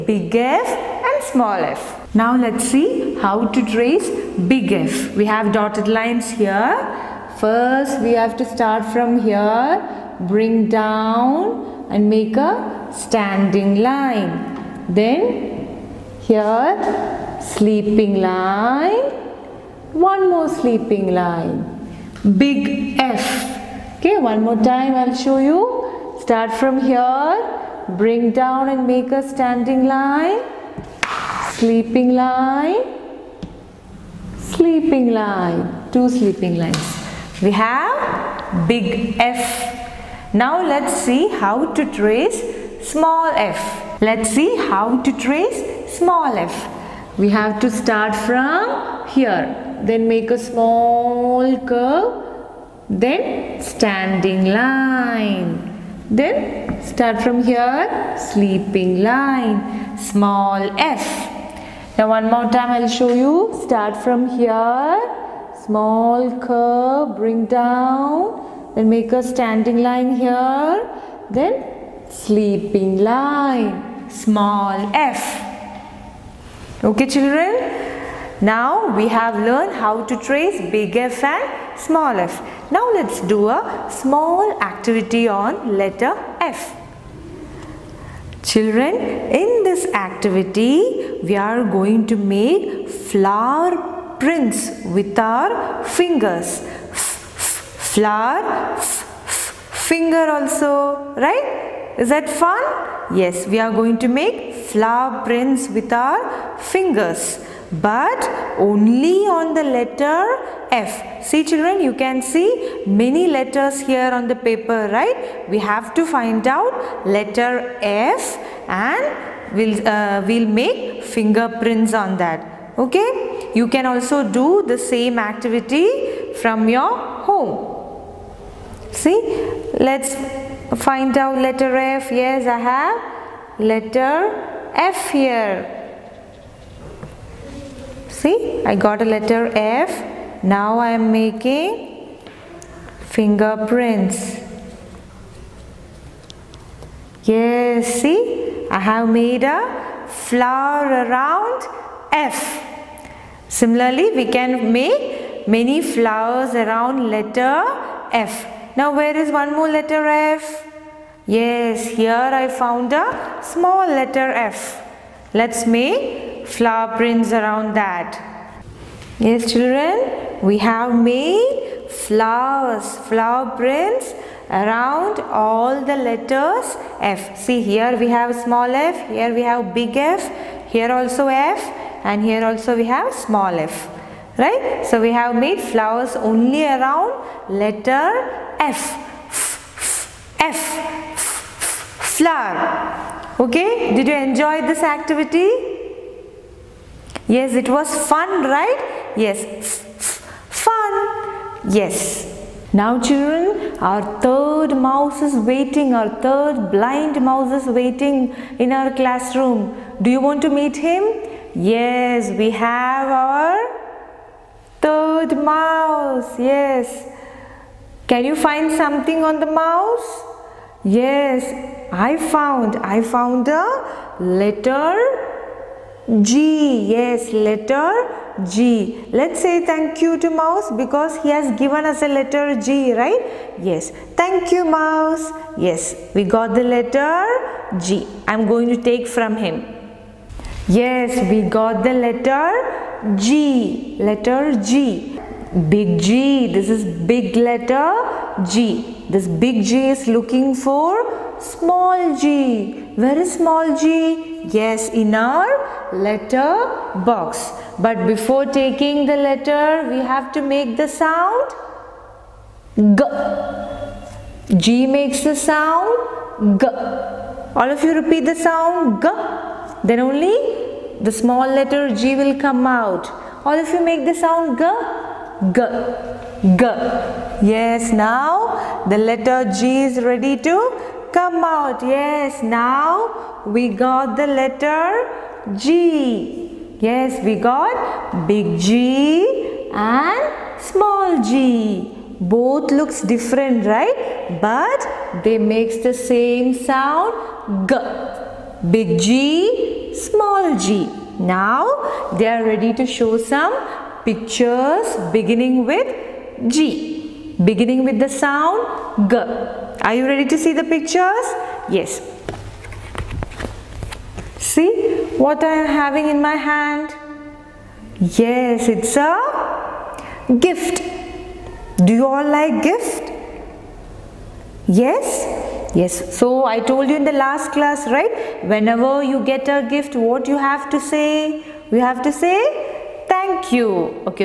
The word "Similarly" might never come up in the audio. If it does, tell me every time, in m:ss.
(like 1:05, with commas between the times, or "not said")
2:33.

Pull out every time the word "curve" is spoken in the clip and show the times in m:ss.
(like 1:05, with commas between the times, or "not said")
0:51, 1:06.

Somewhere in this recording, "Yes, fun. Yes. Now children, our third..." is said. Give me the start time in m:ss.
3:19.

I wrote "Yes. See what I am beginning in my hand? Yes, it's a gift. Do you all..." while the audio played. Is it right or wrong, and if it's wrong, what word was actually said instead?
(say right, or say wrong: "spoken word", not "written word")
wrong: "having", not "beginning".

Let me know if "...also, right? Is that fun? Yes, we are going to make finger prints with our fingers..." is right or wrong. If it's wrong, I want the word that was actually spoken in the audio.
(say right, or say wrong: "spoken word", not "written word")
wrong: "flower", not "finger".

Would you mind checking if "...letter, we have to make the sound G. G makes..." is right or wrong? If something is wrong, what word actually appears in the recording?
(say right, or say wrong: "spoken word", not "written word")
right.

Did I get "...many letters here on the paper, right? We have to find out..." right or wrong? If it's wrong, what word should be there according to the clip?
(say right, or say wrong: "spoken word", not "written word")
right.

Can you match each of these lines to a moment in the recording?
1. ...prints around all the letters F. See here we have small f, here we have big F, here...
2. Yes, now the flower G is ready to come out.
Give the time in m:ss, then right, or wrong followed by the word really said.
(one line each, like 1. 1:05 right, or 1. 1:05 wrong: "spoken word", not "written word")
1. 2:53 right
2. 4:37 wrong: "letter", not "flower".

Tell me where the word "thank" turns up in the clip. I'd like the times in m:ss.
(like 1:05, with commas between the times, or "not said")
3:49, 3:54, 5:33.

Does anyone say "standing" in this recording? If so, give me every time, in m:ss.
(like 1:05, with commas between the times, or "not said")
0:13, 0:29, 0:53, 1:09.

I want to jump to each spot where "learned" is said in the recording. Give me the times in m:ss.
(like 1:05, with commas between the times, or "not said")
1:19.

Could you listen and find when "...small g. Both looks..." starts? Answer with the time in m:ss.
4:50.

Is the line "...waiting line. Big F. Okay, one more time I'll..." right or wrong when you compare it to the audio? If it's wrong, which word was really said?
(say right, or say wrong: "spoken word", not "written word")
wrong: "sleeping", not "waiting".